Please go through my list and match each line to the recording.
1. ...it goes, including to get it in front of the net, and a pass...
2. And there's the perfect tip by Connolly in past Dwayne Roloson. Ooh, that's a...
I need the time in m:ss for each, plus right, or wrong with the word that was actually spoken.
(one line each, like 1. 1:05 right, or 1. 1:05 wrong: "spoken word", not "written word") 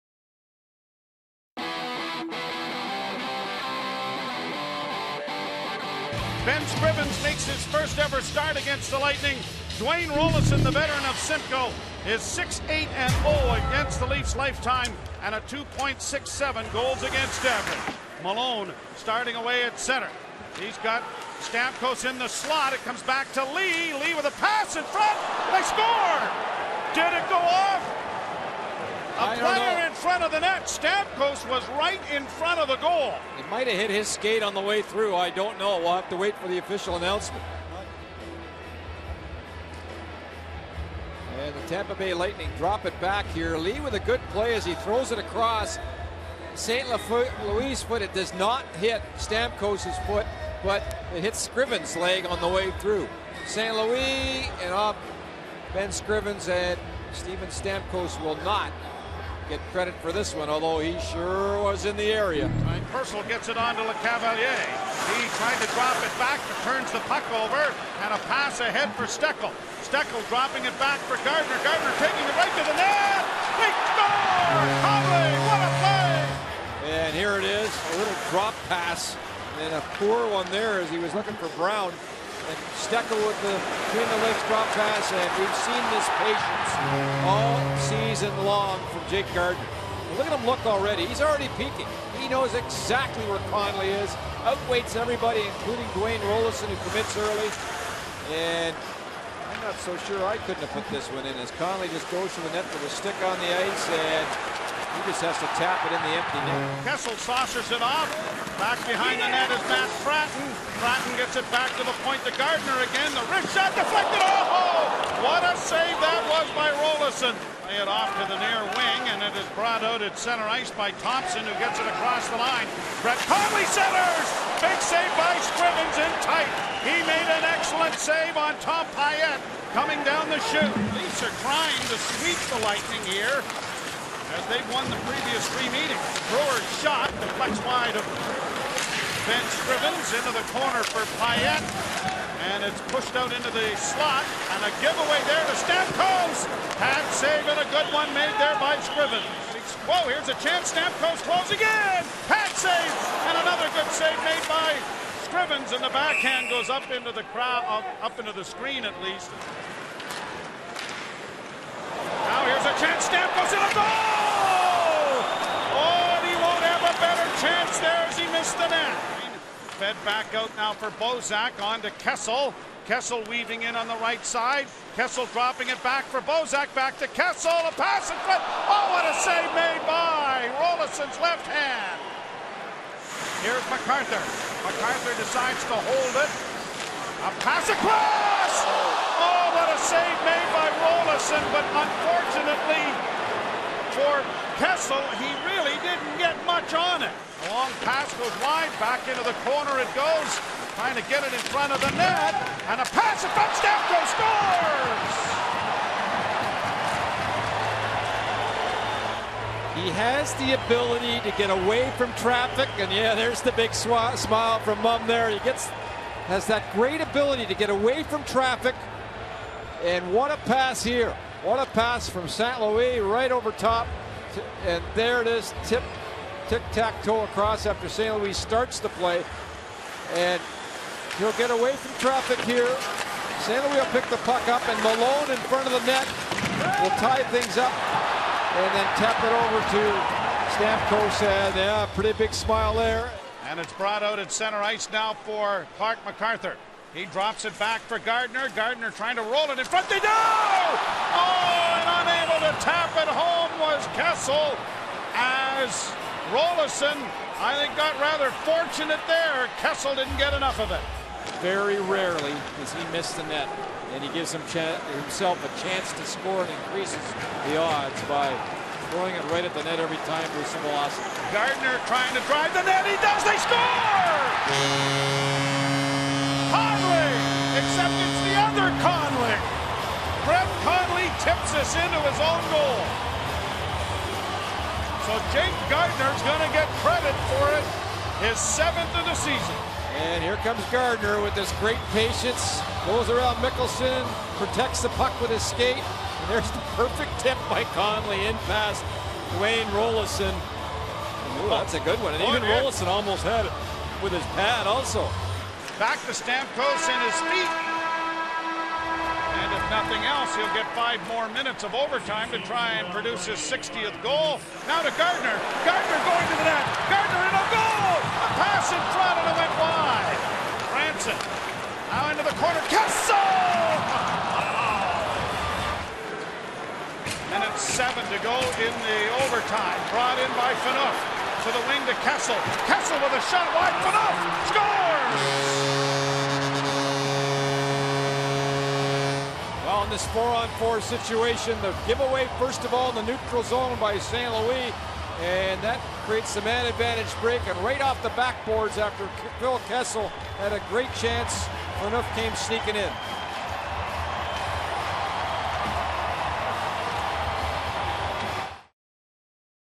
1. 3:19 wrong: "trying", not "including"
2. 4:55 right.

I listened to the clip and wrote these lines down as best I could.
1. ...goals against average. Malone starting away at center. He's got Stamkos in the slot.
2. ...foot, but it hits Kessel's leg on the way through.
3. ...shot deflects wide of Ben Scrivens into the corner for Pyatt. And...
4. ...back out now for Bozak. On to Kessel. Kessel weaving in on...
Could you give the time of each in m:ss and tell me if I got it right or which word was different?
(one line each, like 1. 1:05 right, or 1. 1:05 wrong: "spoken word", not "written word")
1. 0:16 right
2. 0:50 wrong: "Scriven", not "Kessel"
3. 2:16 right
4. 2:50 right.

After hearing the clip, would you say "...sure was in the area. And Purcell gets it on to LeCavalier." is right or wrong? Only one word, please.
right.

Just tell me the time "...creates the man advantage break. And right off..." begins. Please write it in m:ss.
5:46.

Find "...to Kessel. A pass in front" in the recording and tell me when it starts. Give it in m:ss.
2:56.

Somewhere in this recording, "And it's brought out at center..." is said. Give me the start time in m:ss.
4:03.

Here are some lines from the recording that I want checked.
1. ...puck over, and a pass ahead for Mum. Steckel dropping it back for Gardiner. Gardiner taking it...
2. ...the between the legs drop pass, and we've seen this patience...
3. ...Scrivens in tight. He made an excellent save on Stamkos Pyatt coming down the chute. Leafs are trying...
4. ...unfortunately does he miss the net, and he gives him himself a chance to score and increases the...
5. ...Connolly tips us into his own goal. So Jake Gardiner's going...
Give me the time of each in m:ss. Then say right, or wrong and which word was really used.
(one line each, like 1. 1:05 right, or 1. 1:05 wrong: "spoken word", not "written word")
1. 1:07 wrong: "Steckel", not "Mum"
2. 1:23 right
3. 2:05 wrong: "Tom", not "Stamkos"
4. 4:21 wrong: "rarely", not "unfortunately"
5. 4:40 right.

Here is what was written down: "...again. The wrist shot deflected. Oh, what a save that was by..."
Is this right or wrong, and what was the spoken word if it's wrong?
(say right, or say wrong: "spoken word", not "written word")
right.